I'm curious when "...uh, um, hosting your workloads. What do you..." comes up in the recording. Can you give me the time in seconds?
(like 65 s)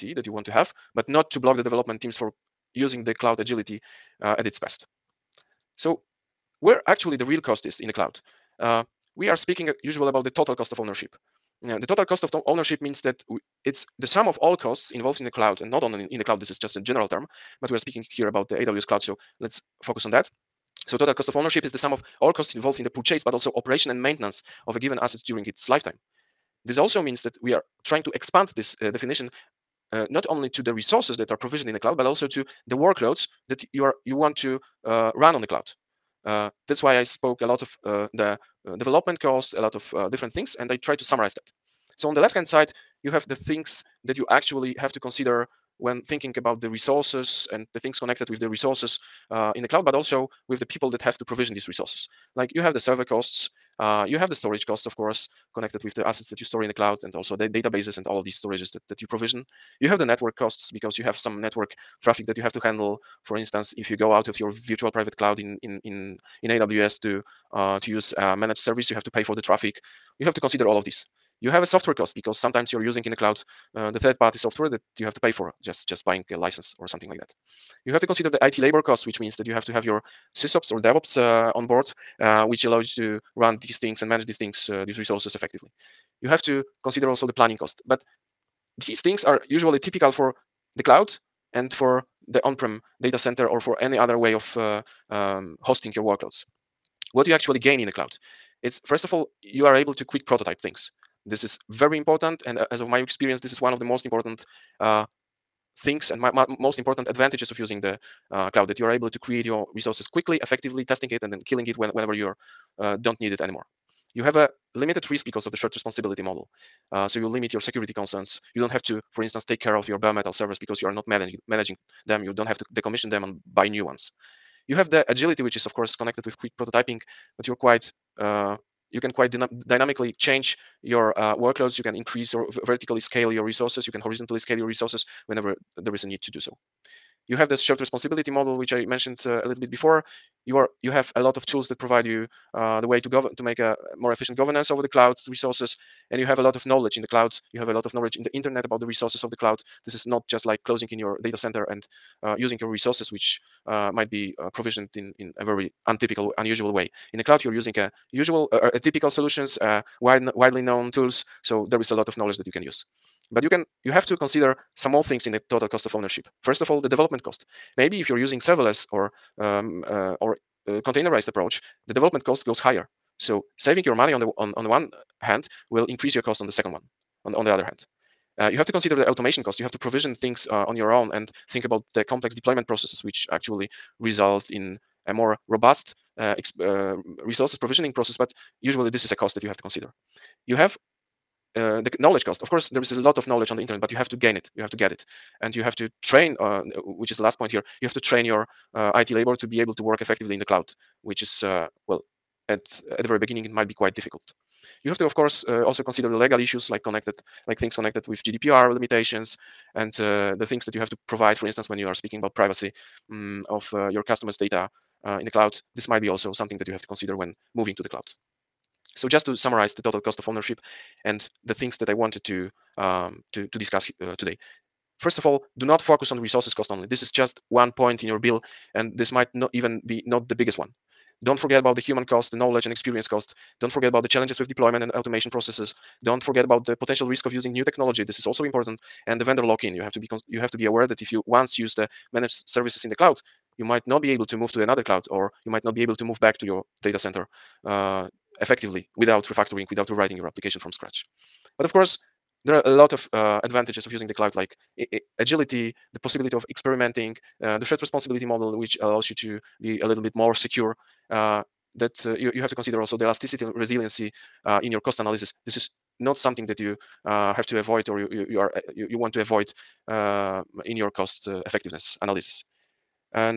94 s.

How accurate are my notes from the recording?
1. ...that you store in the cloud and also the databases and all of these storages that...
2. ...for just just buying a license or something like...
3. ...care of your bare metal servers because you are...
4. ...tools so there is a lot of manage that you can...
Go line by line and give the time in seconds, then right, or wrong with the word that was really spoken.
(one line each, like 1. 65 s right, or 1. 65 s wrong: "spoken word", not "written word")
1. 56 s right
2. 75 s right
3. 119 s right
4. 160 s wrong: "knowledge", not "manage".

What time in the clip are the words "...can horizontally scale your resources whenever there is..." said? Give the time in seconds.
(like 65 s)
133 s.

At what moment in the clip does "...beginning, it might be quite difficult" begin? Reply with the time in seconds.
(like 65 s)
203 s.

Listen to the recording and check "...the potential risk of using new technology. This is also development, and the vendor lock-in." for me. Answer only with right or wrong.
wrong.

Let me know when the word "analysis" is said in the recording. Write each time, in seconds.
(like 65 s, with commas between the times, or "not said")
264 s, 272 s.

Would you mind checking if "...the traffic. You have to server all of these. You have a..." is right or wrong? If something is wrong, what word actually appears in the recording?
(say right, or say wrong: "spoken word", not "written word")
wrong: "consider", not "server".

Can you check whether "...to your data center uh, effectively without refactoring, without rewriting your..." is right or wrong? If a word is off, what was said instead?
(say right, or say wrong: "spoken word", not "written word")
right.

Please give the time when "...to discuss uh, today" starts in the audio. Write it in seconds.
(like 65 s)
223 s.